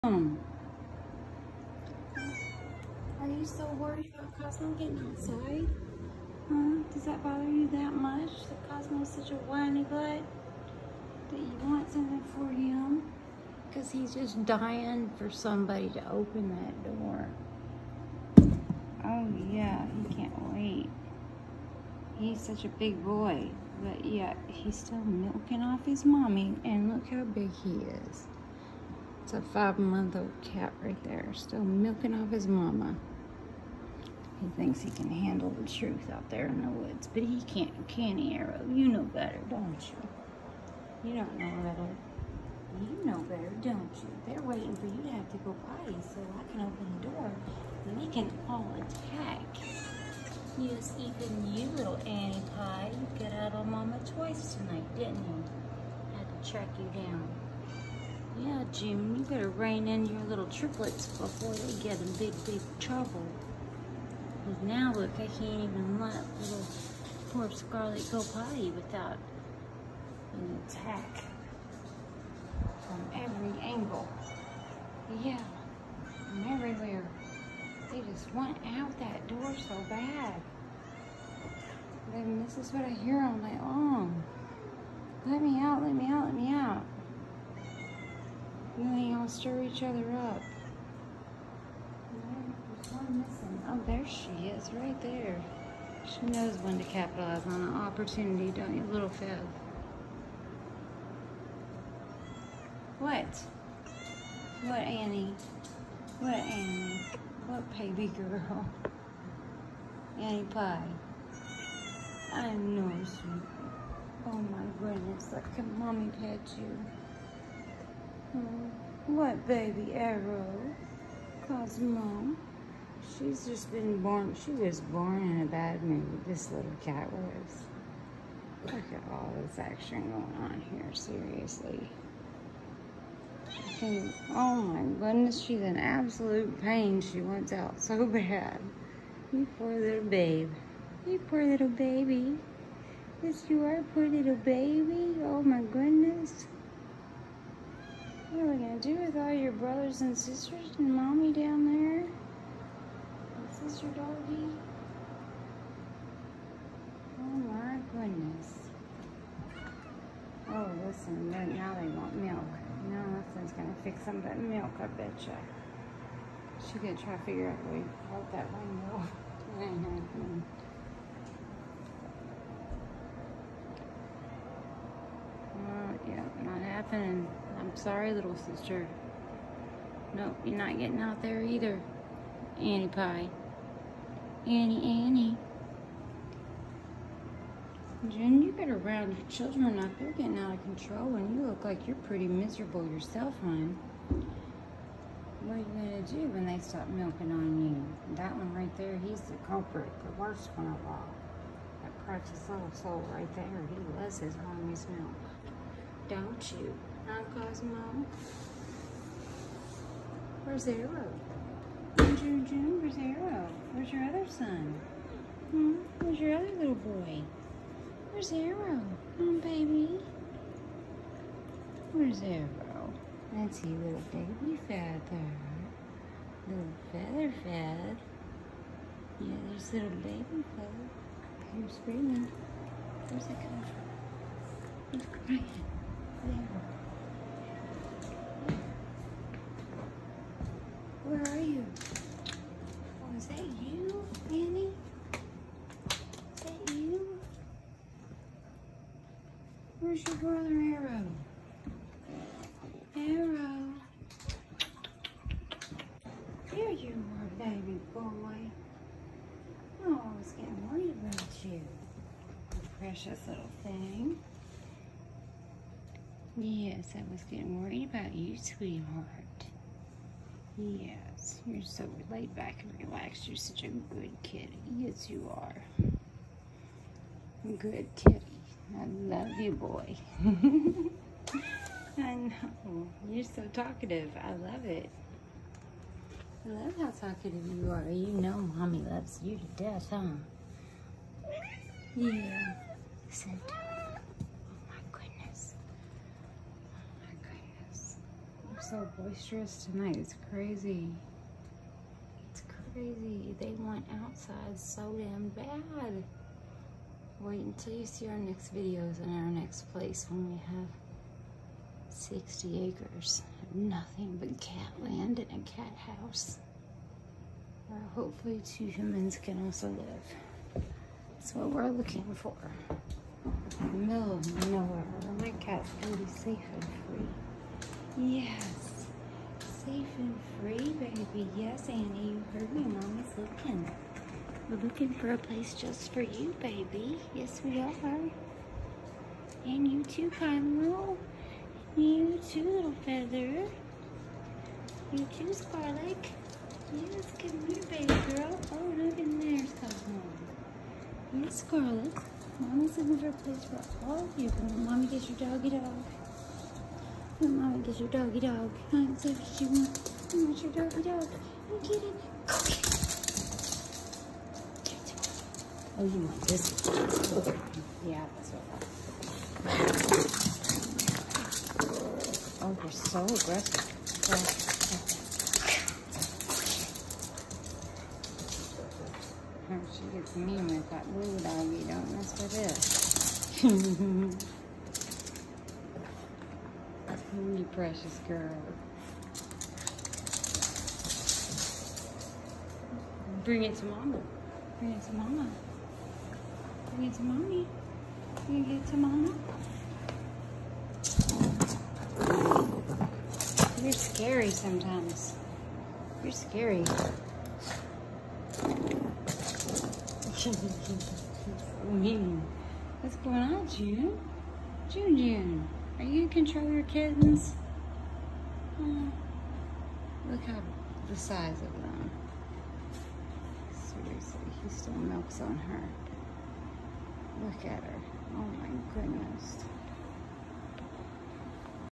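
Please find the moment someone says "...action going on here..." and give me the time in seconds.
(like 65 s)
129 s.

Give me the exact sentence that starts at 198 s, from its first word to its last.
That one right there, he's the culprit, the worst one of all.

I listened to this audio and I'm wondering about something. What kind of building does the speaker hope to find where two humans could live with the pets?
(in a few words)
cat house.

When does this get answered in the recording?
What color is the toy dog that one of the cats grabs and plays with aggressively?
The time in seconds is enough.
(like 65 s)
380 s.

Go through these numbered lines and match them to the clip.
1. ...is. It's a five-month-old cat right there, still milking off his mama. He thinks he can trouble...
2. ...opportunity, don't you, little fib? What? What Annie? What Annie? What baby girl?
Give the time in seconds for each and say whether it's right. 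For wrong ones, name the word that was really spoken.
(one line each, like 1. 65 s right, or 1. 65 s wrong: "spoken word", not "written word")
1. 28 s wrong: "handle", not "trouble"
2. 97 s right.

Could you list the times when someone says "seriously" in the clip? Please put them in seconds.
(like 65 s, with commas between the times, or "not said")
130 s, 423 s.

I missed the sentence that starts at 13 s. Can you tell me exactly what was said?
Because he's just dying for somebody to open that door.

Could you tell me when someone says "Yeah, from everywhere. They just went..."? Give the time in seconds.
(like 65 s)
75 s.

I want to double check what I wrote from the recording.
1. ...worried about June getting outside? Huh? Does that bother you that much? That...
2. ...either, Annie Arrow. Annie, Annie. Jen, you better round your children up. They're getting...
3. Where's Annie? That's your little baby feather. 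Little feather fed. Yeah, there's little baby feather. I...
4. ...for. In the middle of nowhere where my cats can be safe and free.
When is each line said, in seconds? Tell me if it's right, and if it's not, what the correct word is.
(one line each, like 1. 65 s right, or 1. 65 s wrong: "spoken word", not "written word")
1. 3 s wrong: "Cosmo", not "June"
2. 181 s wrong: "Pie", not "Arrow"
3. 221 s wrong: "Arrow", not "Annie"
4. 322 s right.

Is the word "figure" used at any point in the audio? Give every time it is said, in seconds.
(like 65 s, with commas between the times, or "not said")
167 s.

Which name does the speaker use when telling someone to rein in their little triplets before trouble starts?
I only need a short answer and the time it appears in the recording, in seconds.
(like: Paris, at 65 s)
Jim, at 58 s.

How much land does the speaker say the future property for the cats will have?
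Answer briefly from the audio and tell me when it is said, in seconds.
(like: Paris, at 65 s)
60 acres, at 311 s.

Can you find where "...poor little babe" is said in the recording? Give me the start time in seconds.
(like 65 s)
139 s.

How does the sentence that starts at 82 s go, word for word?
Then this is what I hear all night long.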